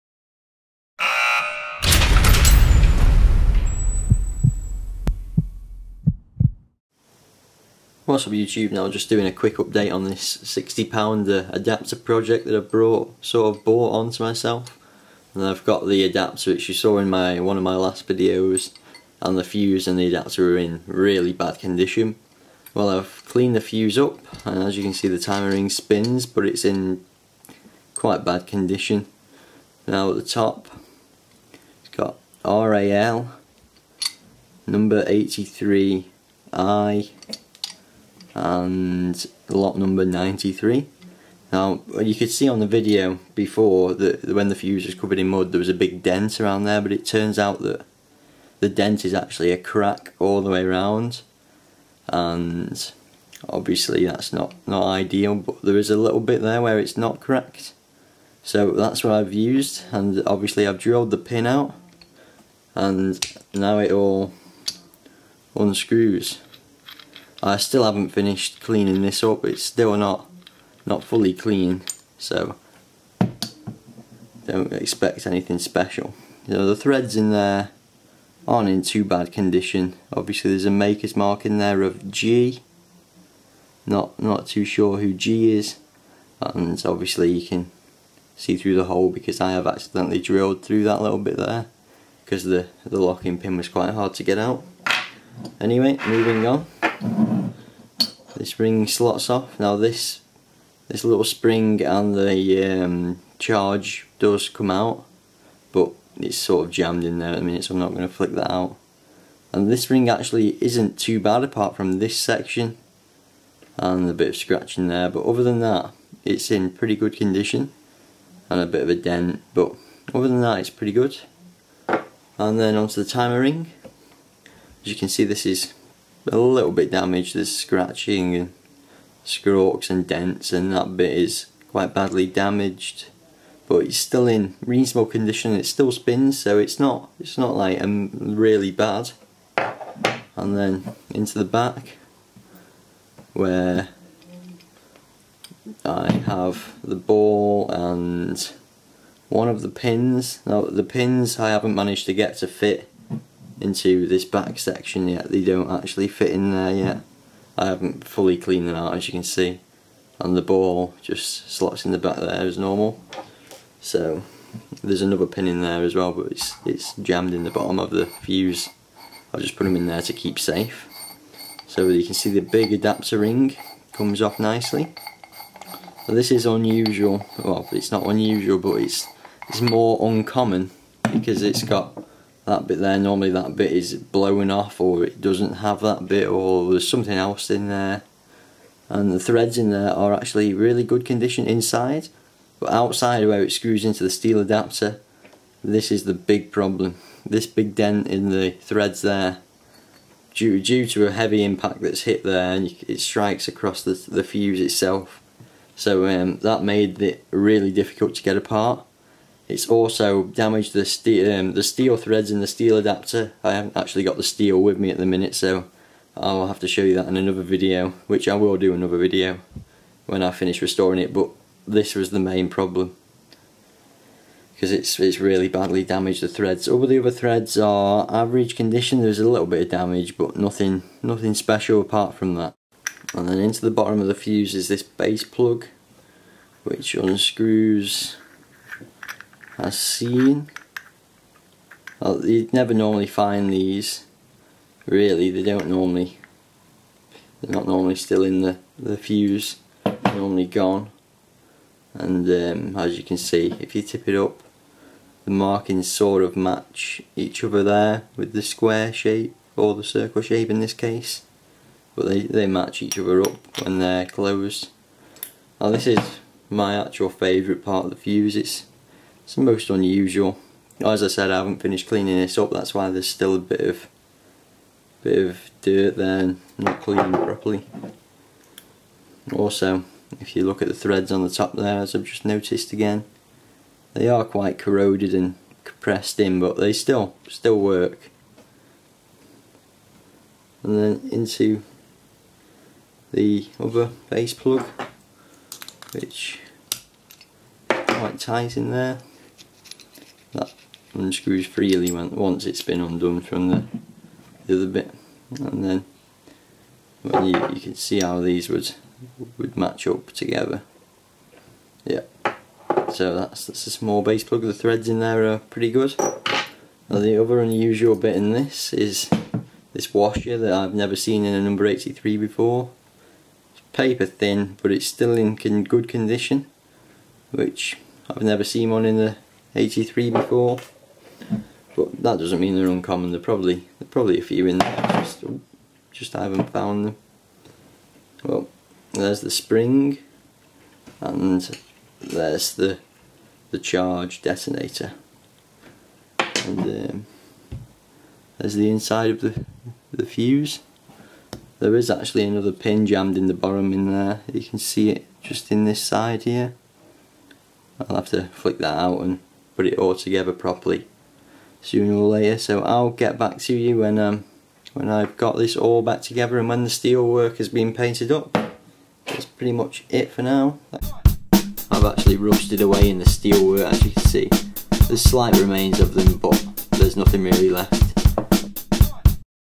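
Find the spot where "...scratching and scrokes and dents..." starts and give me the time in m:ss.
2:07.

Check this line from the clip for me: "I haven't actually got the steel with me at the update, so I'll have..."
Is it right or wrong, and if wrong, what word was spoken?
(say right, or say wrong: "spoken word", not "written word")
wrong: "minute", not "update".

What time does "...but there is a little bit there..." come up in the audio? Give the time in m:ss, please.
0:55.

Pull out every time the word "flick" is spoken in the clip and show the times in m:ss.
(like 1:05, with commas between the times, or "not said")
1:48, 5:58.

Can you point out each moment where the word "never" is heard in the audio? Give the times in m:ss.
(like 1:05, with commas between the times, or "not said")
4:02, 5:20, 5:28.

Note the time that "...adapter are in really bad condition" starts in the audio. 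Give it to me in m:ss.
0:20.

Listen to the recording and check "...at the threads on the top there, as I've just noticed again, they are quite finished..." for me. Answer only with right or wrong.
wrong.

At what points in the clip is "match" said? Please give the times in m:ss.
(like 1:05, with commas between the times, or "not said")
4:16, 4:22, 5:09.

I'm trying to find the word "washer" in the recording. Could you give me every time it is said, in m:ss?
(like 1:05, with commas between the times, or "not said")
5:19.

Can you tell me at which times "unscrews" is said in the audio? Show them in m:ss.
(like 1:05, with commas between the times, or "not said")
1:05, 3:56, 5:00.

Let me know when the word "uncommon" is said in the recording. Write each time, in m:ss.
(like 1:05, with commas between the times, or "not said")
3:00, 5:32.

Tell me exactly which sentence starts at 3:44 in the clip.
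Because it's, it's really badly damaged, the threads.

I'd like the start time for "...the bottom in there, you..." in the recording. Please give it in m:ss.
5:53.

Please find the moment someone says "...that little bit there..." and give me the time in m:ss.
1:30.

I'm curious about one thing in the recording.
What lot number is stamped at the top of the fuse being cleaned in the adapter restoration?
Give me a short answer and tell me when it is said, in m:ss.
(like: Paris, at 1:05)
93, at 0:39.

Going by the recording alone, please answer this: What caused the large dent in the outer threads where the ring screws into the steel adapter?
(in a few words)
A heavy impact.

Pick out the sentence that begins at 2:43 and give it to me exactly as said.
So there's another pin in there as well but it's, it's jammed in the bottom of the fuse.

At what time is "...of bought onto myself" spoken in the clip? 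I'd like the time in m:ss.
0:13.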